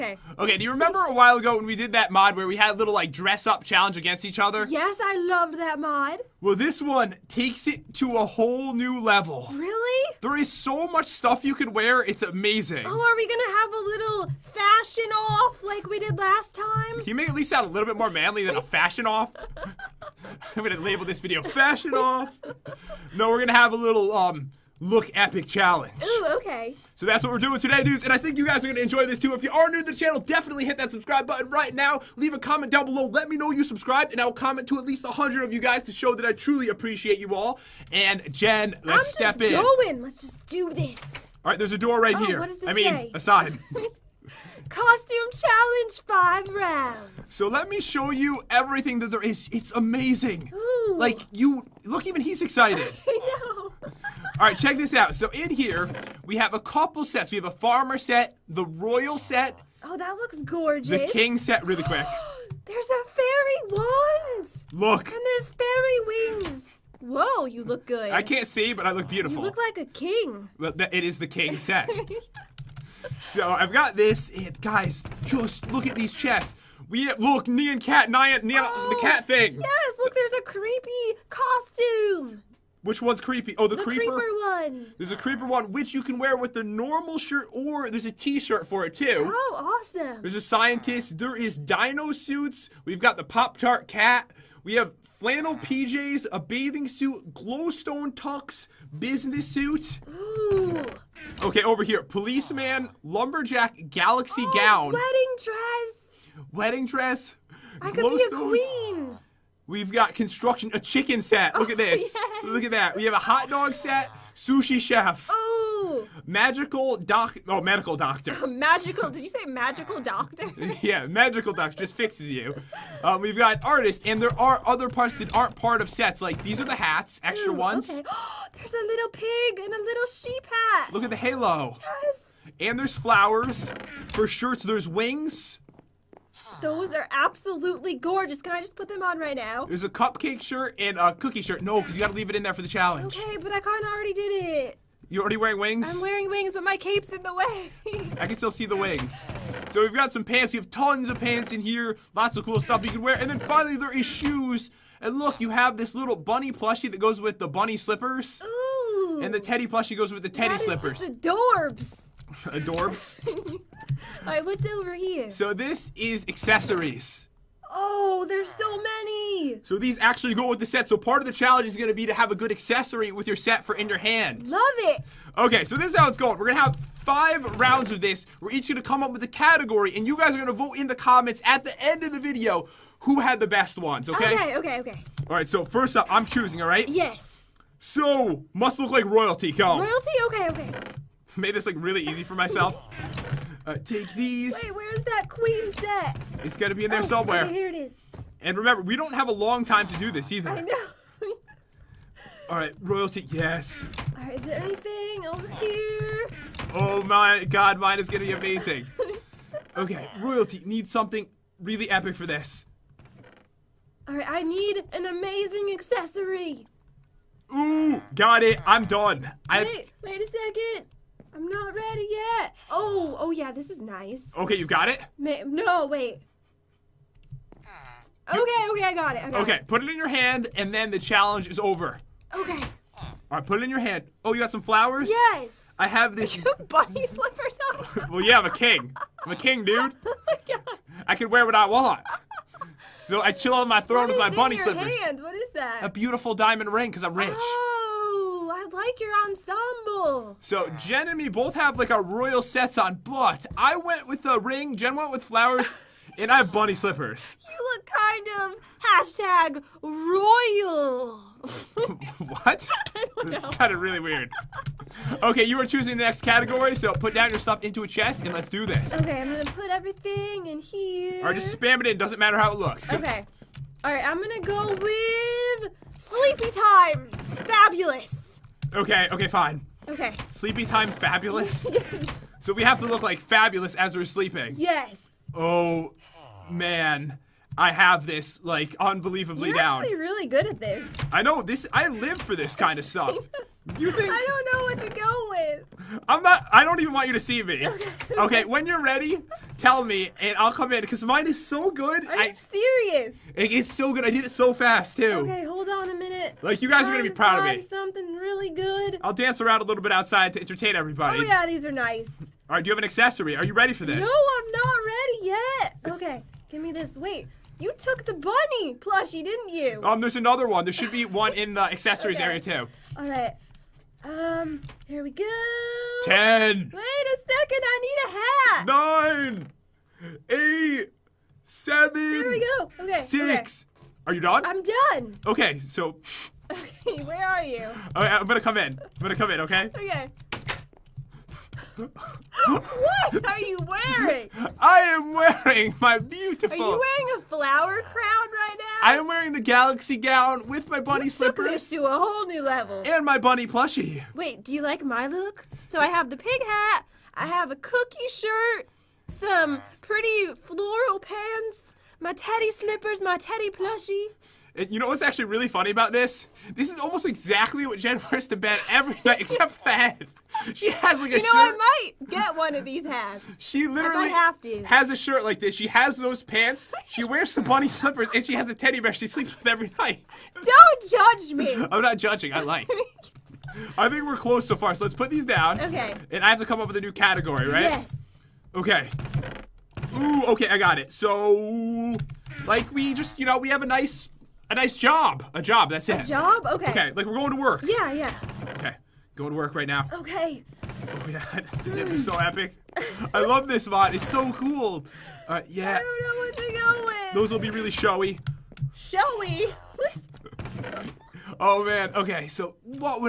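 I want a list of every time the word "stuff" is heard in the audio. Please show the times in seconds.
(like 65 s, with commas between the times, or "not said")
11 s, 152 s, 267 s, 292 s.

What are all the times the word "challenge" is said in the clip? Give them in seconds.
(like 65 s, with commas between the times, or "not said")
3 s, 25 s, 45 s, 142 s, 171 s, 230 s.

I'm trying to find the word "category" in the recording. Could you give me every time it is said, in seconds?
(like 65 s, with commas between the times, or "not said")
179 s, 266 s, 386 s.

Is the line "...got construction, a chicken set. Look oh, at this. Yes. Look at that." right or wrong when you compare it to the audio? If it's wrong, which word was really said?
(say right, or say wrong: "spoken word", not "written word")
right.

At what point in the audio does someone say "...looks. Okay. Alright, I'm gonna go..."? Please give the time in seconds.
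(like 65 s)
272 s.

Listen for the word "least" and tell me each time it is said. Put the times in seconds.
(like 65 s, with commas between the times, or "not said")
17 s, 34 s.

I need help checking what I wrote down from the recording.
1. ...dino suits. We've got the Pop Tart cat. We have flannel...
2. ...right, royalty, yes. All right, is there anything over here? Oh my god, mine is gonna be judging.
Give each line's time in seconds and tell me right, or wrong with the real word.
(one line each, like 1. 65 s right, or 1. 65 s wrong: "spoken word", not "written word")
1. 91 s right
2. 202 s wrong: "amazing", not "judging".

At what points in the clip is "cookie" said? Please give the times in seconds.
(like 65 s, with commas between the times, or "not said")
141 s, 357 s.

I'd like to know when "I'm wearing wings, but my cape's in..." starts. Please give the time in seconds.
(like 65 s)
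145 s.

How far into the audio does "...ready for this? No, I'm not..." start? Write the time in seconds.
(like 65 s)
313 s.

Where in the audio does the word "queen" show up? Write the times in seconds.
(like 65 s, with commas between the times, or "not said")
108 s, 195 s.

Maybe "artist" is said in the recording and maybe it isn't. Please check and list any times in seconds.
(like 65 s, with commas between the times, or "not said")
123 s.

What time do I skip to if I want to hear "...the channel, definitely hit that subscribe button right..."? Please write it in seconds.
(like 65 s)
29 s.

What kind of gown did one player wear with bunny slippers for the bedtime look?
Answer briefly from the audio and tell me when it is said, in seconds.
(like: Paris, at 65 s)
Galaxy gown, at 349 s.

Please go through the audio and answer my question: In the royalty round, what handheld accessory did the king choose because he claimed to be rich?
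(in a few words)
Diamond ring.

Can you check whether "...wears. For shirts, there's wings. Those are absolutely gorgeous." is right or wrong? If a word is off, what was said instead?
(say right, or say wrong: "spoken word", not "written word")
wrong: "flowers", not "wears".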